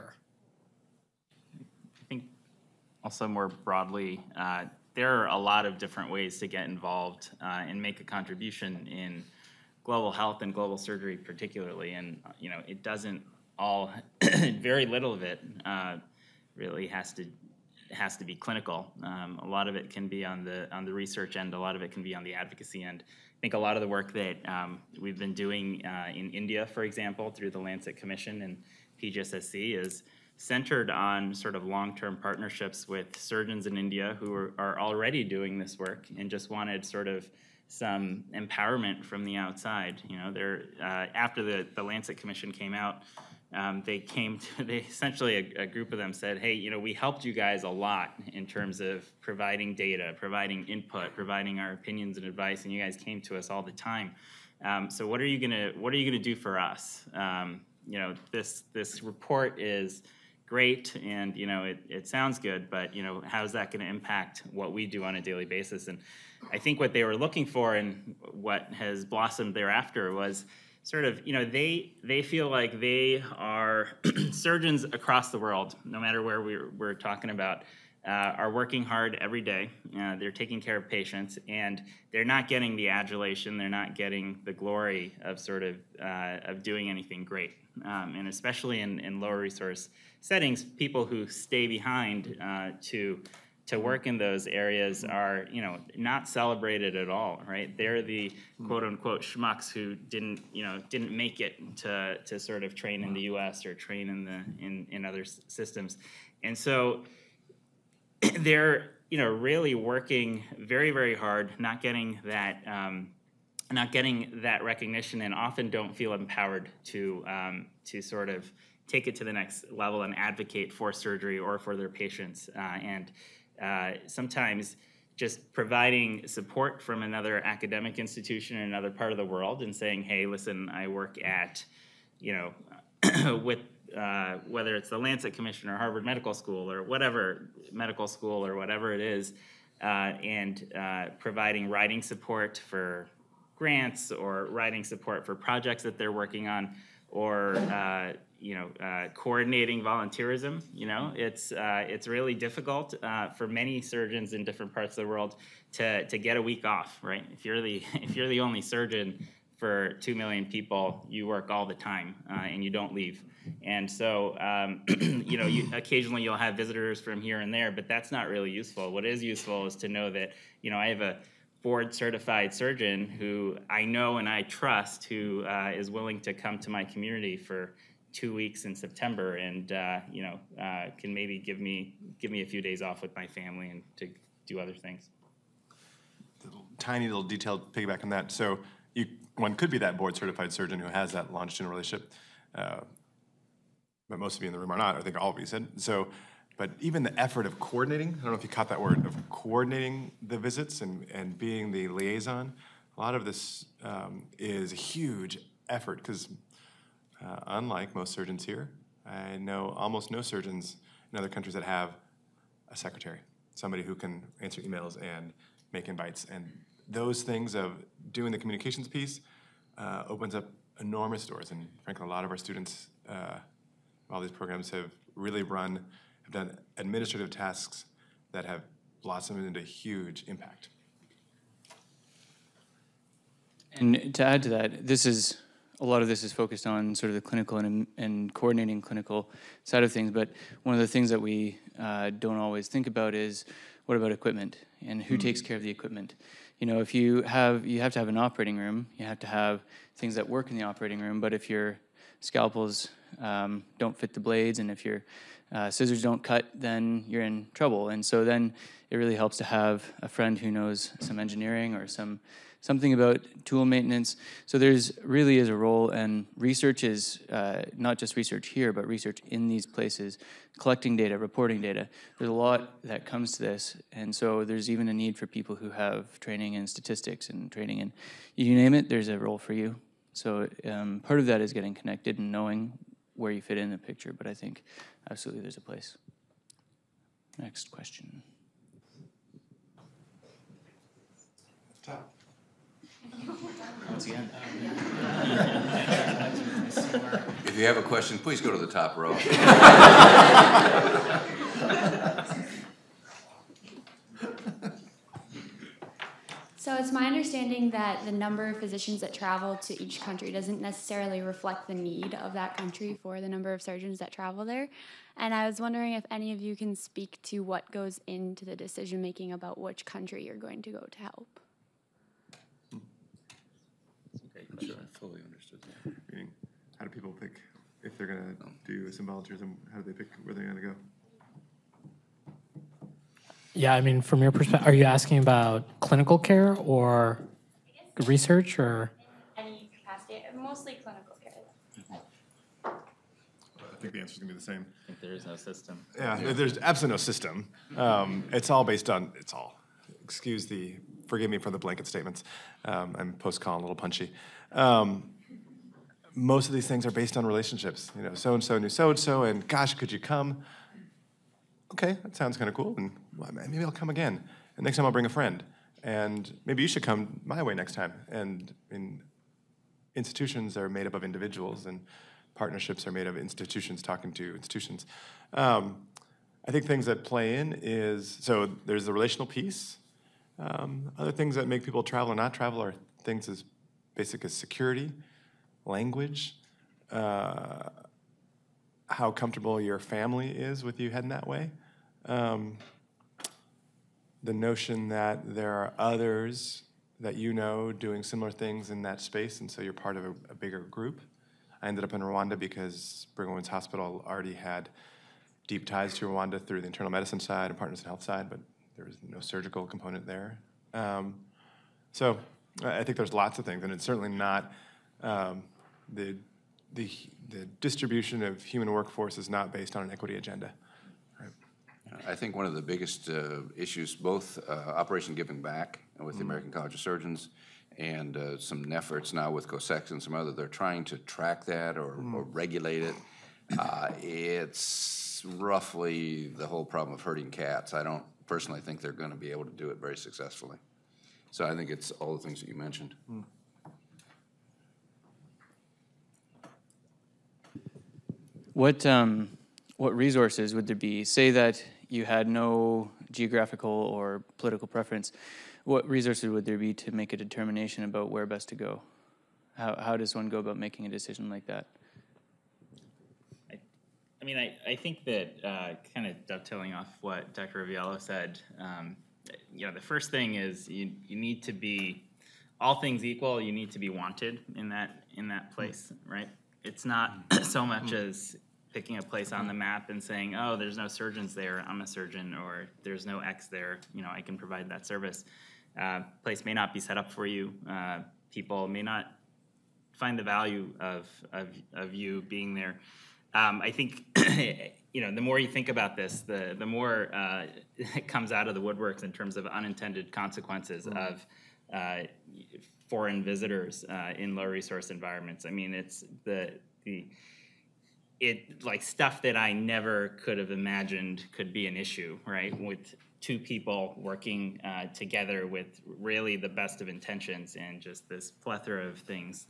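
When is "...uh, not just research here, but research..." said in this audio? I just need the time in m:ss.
4:27.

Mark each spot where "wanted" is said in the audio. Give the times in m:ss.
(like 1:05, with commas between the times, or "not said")
0:36, 7:53.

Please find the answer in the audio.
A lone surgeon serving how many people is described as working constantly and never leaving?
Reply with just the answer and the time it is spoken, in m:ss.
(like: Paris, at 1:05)
2 million, at 2:39.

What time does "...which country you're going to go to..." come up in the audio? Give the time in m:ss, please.
5:19.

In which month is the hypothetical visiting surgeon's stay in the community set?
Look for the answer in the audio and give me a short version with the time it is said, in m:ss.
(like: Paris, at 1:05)
September, at 2:58.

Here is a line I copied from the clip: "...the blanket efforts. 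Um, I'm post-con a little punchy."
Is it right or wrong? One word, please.
wrong.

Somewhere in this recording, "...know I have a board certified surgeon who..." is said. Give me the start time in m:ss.
2:50.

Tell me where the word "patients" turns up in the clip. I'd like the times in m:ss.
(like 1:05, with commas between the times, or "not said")
1:20, 2:01.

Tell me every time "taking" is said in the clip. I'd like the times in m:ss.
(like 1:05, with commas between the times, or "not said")
1:20.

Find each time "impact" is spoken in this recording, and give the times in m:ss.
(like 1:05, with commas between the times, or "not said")
1:03, 3:50.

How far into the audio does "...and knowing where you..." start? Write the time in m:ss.
4:42.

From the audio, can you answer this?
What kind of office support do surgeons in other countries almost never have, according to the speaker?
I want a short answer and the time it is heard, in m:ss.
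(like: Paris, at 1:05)
a secretary, at 3:32.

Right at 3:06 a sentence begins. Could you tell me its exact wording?
tiny little detailed piggyback on that.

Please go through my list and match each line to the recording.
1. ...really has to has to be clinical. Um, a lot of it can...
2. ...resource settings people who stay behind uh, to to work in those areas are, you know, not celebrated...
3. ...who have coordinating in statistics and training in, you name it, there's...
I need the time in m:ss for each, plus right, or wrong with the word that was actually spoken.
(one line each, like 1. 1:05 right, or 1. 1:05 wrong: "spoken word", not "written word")
1. 0:16 right
2. 1:29 right
3. 4:35 wrong: "training", not "coordinating".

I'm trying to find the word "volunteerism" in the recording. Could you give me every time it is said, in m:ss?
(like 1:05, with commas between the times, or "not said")
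2:29, 5:29.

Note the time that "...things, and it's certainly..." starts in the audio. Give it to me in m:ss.
6:53.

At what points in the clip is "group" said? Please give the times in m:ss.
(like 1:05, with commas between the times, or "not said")
0:45, 6:40.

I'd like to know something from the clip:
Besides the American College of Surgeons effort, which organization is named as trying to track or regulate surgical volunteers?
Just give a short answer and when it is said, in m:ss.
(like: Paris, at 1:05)
COSECSA, at 7:09.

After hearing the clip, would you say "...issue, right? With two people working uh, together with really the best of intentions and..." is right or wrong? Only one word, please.
right.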